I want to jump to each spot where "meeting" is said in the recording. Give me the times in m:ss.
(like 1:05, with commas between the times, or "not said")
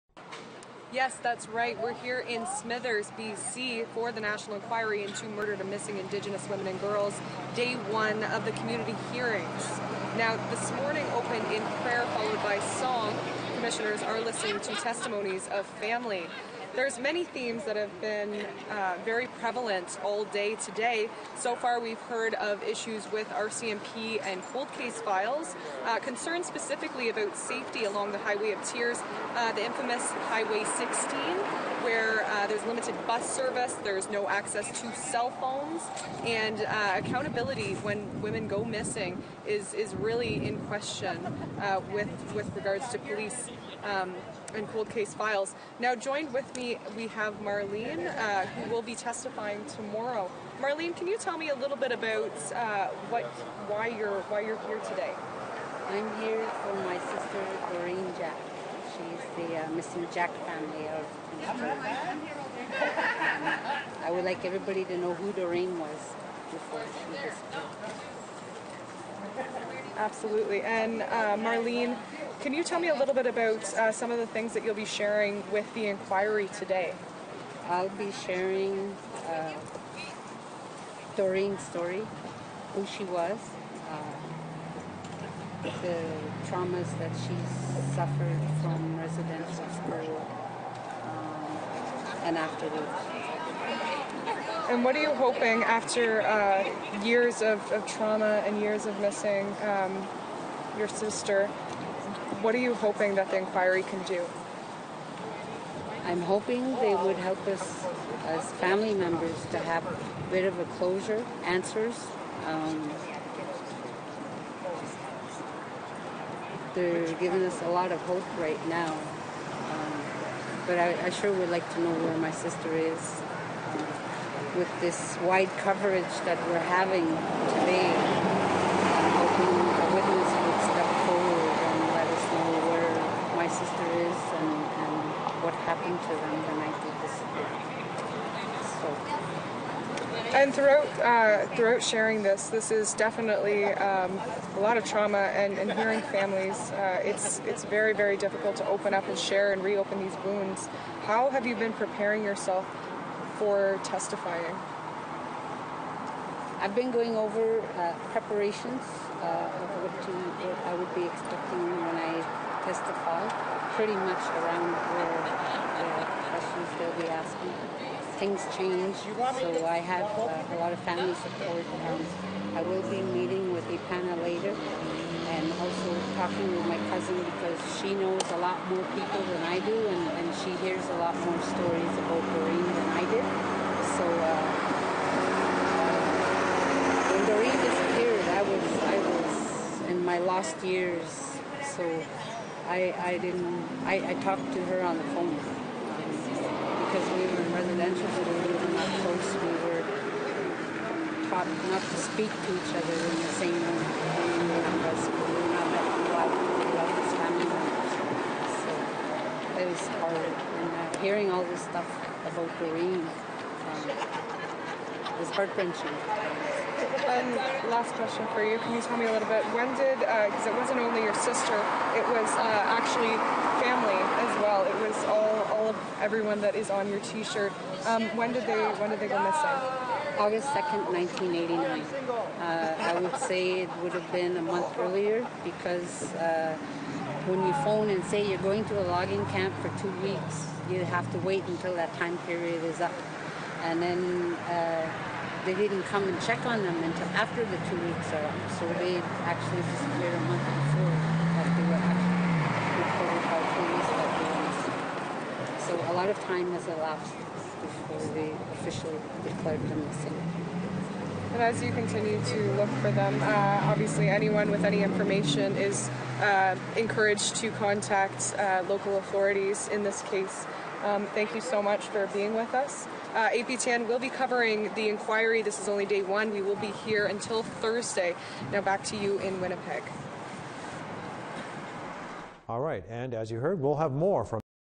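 2:53.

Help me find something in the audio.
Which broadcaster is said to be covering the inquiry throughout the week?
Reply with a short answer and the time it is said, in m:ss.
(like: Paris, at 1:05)
APTN, at 4:33.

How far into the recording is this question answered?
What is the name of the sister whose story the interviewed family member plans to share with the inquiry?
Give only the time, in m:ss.
0:57.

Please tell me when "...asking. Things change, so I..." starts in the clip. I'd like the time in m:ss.
2:47.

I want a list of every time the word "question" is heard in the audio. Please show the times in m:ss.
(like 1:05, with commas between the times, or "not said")
0:40, 2:46, 3:37.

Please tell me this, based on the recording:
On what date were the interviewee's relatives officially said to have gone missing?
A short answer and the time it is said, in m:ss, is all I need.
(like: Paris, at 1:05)
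August 2nd, 1989, at 3:50.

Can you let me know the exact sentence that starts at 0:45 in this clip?
Now, joined with me, we have Marlene, uh, who will be testifying tomorrow.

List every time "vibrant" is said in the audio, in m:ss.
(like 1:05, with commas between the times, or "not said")
not said.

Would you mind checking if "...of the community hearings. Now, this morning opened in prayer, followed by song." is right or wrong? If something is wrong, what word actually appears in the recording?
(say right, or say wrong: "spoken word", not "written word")
right.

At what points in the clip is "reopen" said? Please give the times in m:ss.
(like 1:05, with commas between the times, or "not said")
2:29.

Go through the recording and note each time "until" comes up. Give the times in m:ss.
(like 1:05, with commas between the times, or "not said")
4:01, 4:06, 4:37.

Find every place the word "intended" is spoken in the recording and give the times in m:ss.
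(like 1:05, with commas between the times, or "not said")
not said.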